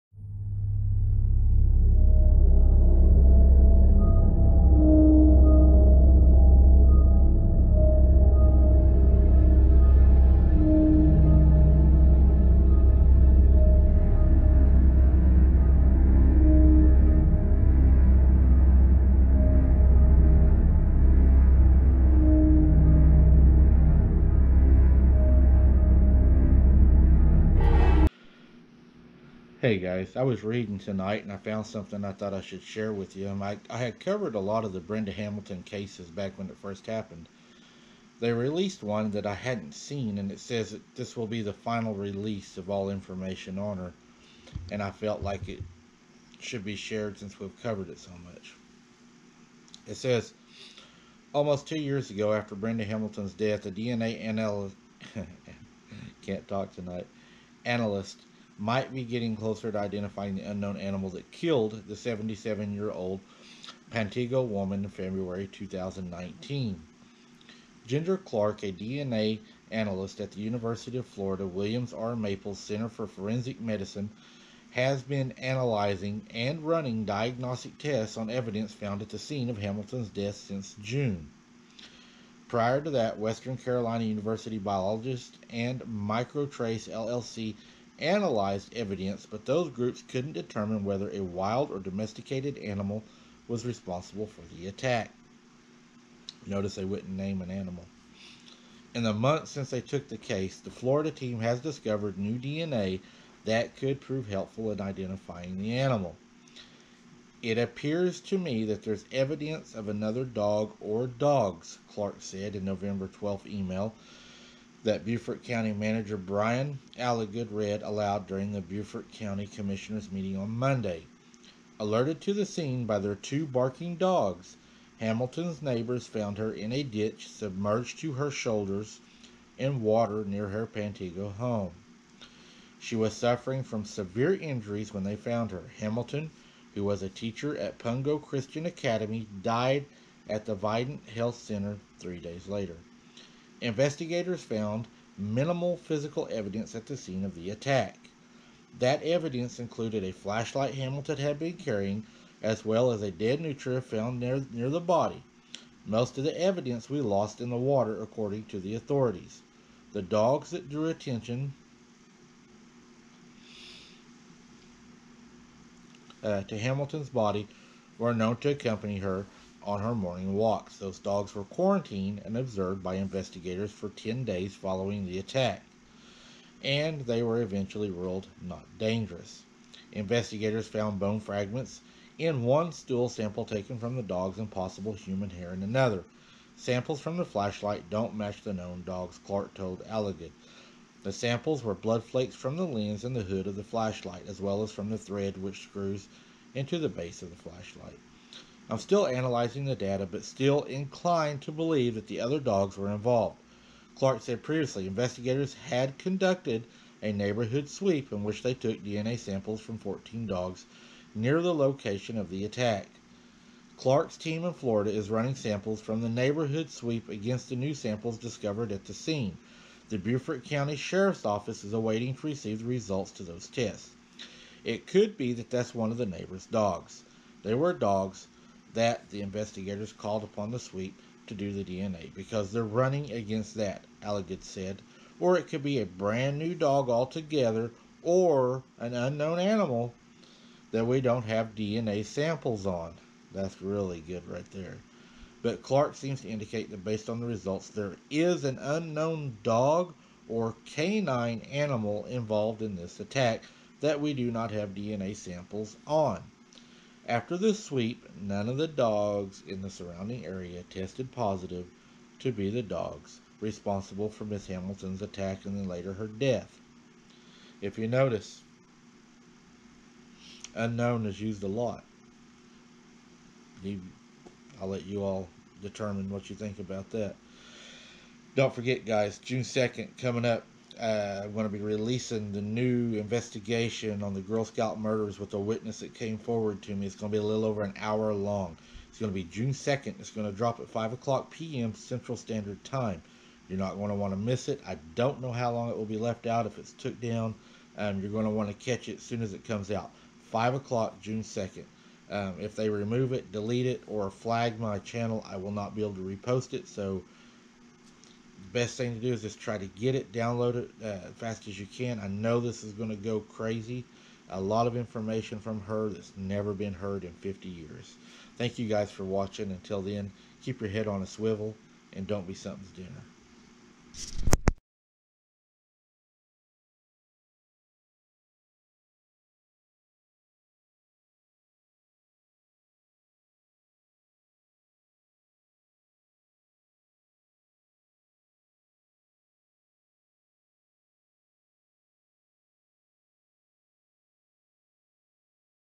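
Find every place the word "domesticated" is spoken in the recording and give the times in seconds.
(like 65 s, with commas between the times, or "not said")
91 s.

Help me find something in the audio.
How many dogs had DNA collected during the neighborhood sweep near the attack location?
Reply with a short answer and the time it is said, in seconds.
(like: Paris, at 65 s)
14, at 209 s.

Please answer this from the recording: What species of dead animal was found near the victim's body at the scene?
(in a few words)
Nutria.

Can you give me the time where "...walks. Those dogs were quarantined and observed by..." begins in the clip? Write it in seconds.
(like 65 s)
170 s.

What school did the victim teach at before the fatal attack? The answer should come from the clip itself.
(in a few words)
Pungo Christian Academy.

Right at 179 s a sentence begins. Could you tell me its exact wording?
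Investigators found bone fragments in one stool sample taken from the dogs and possible human hair in another.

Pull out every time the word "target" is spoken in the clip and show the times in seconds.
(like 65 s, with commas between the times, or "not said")
not said.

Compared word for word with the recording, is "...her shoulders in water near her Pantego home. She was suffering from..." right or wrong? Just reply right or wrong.
right.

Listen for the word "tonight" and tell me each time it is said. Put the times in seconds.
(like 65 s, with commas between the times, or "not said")
30 s, 56 s.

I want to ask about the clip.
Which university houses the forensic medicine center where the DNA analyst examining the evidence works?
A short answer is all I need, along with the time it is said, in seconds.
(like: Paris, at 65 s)
University of Florida, at 70 s.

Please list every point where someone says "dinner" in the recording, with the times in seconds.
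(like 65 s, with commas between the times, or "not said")
322 s.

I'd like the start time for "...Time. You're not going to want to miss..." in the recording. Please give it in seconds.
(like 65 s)
292 s.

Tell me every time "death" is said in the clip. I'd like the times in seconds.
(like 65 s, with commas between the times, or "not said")
53 s, 80 s, 266 s.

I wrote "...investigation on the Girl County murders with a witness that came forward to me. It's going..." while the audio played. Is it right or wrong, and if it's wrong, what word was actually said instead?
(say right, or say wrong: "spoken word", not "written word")
wrong: "Scout", not "County".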